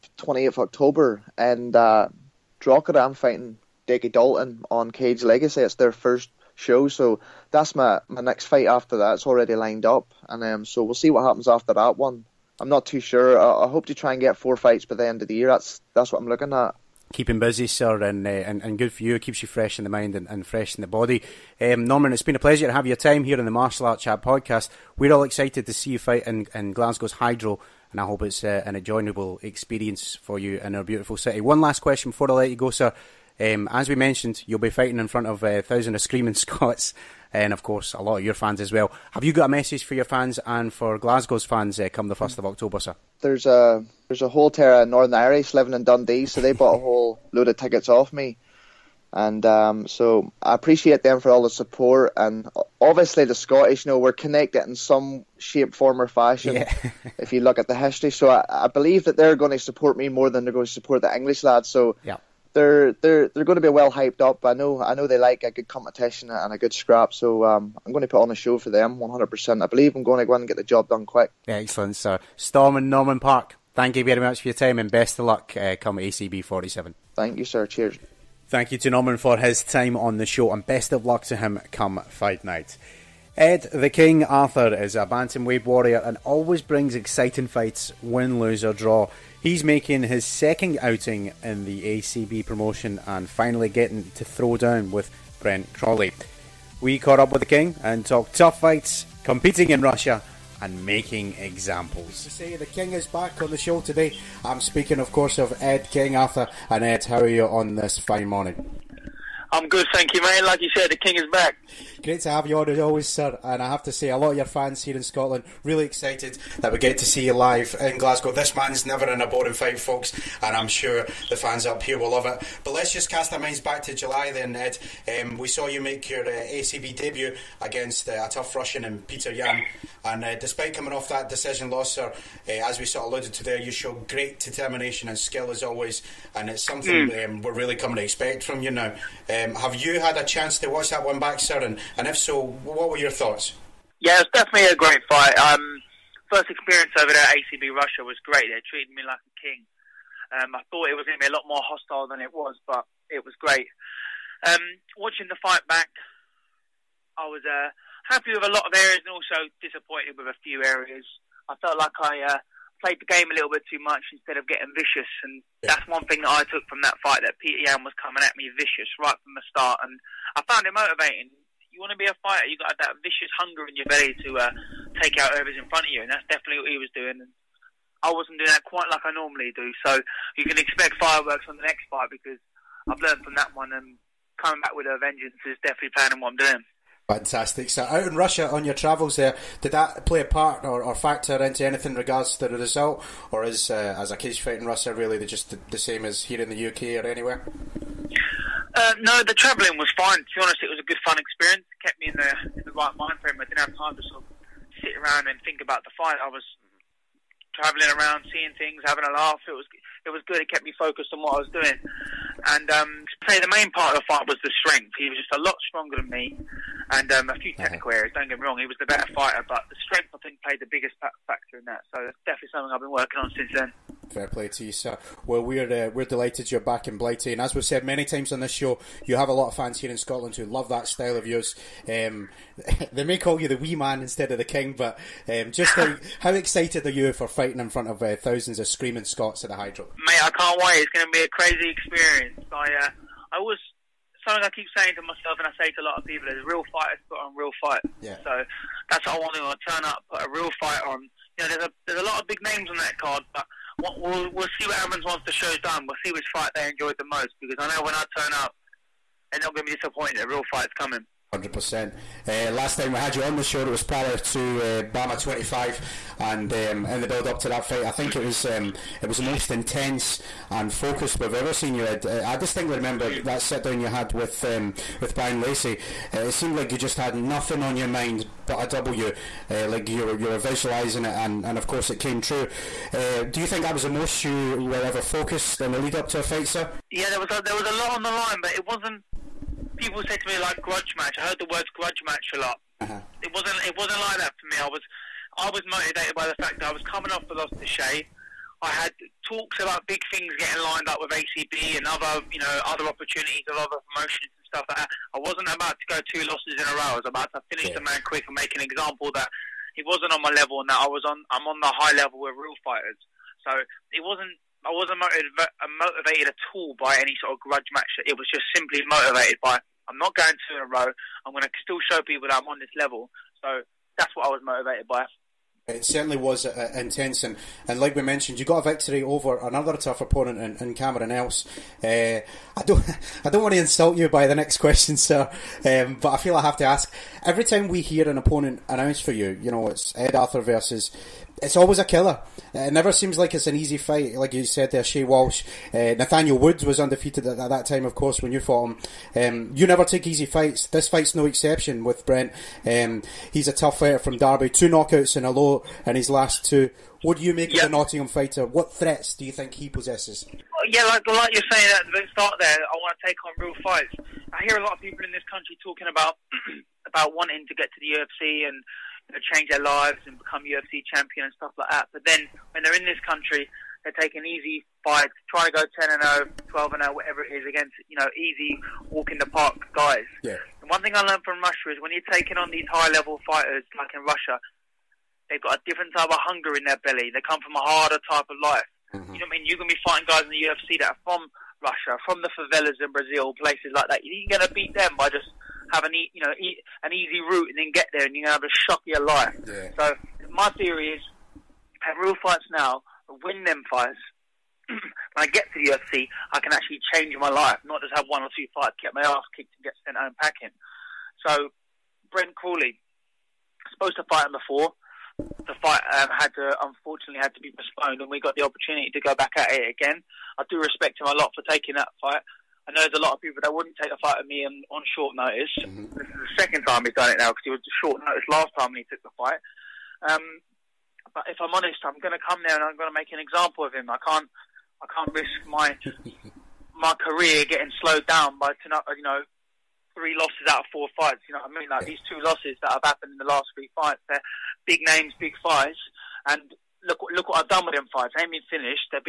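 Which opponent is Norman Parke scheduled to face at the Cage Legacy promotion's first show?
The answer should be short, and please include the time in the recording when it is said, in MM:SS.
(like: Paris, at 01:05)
Dickie Dalton, at 00:03.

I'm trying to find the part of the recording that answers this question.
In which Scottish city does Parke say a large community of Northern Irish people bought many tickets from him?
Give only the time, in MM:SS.
00:45.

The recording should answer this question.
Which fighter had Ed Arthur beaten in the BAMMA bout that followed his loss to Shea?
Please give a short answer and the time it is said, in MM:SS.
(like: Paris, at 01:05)
Cameron Else, at 05:30.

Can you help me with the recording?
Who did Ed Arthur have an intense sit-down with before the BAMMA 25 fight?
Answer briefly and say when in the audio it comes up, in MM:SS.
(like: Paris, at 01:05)
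Bryan Lacey, at 04:35.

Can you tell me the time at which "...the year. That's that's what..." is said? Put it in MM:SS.
00:15.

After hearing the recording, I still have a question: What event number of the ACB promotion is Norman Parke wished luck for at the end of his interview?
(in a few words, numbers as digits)
47.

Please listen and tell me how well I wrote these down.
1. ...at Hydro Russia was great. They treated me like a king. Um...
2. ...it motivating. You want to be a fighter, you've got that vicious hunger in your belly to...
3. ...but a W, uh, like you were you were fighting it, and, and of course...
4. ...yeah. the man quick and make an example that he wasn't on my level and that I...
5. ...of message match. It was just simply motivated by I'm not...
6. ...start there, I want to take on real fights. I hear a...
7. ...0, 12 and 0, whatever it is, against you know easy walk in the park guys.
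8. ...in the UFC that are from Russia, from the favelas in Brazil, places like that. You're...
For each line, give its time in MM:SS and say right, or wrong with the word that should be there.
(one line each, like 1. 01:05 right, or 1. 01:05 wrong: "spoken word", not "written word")
1. 02:27 wrong: "ACB", not "Hydro"
2. 02:50 right
3. 04:38 wrong: "visualising", not "fighting"
4. 05:07 right
5. 05:17 wrong: "grudge", not "message"
6. 06:02 right
7. 06:16 right
8. 06:30 right.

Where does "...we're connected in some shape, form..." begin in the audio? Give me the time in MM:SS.
00:53.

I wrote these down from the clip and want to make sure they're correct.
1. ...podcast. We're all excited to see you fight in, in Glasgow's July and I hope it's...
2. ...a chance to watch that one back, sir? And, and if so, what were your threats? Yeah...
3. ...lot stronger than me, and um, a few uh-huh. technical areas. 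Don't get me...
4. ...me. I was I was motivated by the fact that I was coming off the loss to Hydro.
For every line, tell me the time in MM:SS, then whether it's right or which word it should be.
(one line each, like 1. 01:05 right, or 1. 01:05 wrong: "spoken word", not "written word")
1. 00:24 wrong: "Hydro", not "July"
2. 02:20 wrong: "thoughts", not "threats"
3. 03:35 right
4. 04:54 wrong: "Shea", not "Hydro".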